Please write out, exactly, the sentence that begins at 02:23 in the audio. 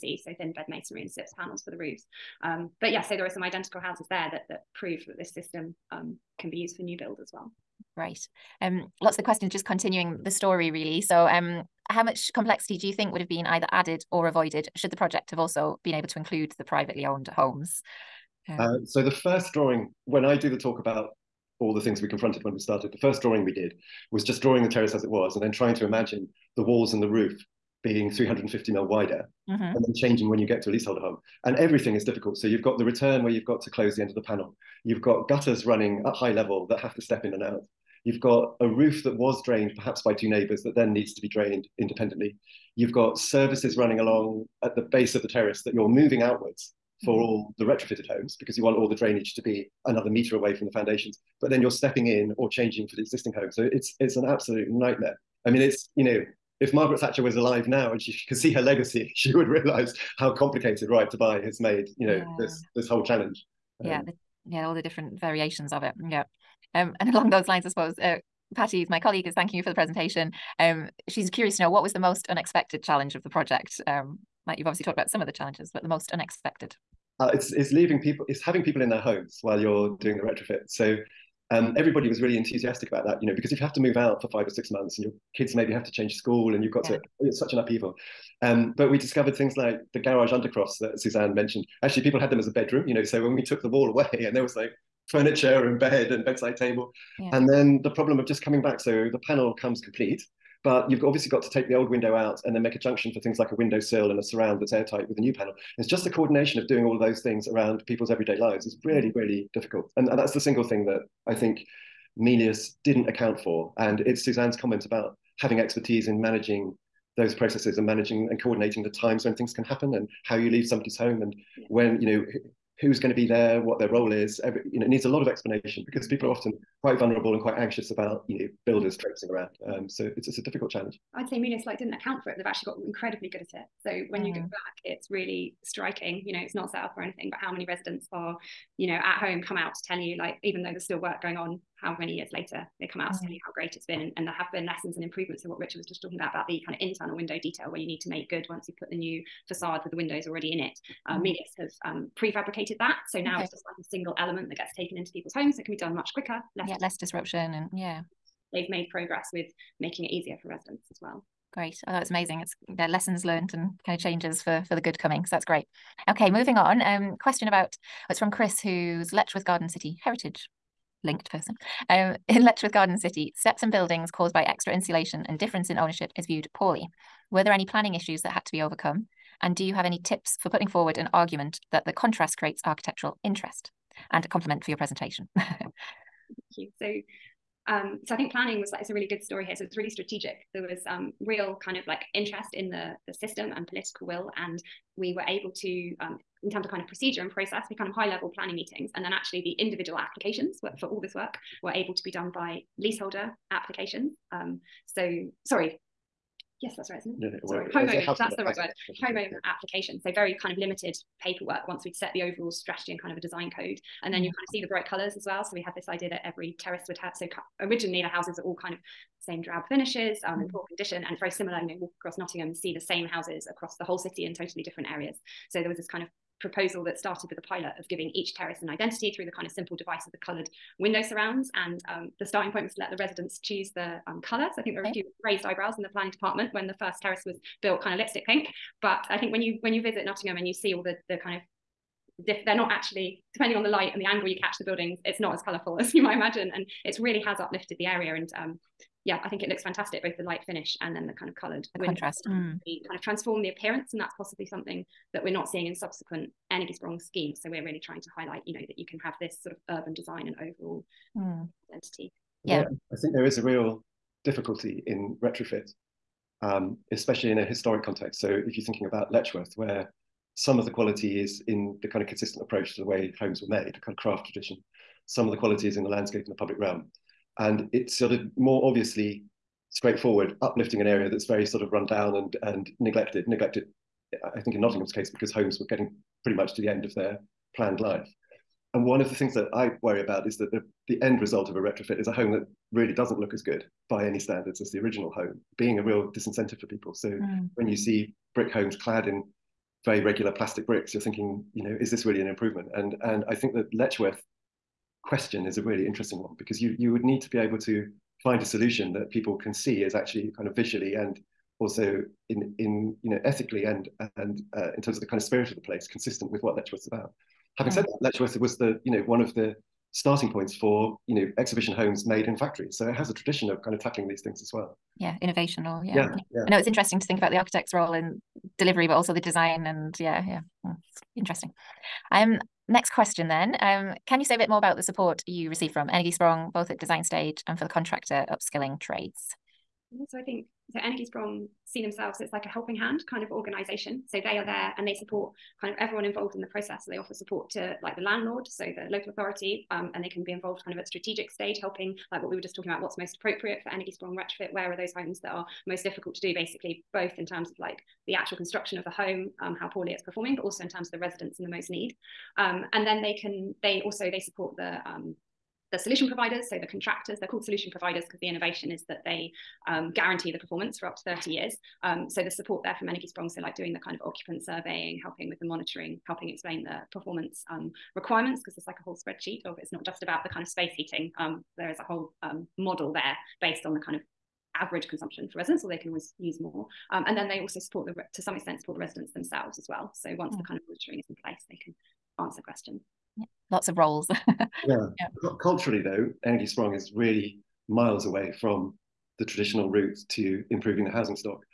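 telling you how great it's been.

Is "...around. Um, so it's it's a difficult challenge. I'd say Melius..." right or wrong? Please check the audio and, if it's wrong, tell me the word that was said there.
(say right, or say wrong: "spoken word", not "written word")
right.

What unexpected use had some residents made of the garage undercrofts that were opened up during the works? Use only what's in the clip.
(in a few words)
a bedroom.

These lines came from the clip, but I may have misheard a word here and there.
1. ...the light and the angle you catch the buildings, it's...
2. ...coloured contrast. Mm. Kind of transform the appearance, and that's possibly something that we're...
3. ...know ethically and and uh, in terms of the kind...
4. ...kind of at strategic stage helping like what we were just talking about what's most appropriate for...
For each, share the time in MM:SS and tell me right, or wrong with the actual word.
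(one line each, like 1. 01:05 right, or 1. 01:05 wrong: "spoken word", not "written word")
1. 04:03 right
2. 04:11 right
3. 05:13 right
4. 05:50 right.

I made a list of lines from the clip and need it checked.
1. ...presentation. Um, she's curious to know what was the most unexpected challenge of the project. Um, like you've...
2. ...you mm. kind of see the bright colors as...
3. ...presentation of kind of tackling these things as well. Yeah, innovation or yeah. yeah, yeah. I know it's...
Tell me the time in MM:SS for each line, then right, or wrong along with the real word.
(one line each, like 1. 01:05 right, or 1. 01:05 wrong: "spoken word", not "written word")
1. 01:09 right
2. 03:34 right
3. 05:23 wrong: "tradition", not "presentation".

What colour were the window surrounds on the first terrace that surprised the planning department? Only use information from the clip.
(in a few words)
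lipstick pink.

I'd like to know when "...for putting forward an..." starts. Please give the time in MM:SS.
03:00.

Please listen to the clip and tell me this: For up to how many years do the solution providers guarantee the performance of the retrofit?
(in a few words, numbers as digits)
30 years.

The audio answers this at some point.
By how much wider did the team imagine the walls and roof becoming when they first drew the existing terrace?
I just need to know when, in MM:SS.
00:28.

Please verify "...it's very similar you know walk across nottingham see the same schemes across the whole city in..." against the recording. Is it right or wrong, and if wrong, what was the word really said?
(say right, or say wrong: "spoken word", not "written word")
wrong: "houses", not "schemes".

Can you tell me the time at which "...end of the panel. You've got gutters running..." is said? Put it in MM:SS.
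00:34.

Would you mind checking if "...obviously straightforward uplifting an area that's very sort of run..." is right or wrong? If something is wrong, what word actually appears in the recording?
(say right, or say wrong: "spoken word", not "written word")
right.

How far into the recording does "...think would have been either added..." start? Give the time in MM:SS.
00:12.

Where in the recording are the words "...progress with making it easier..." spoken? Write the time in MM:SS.
02:38.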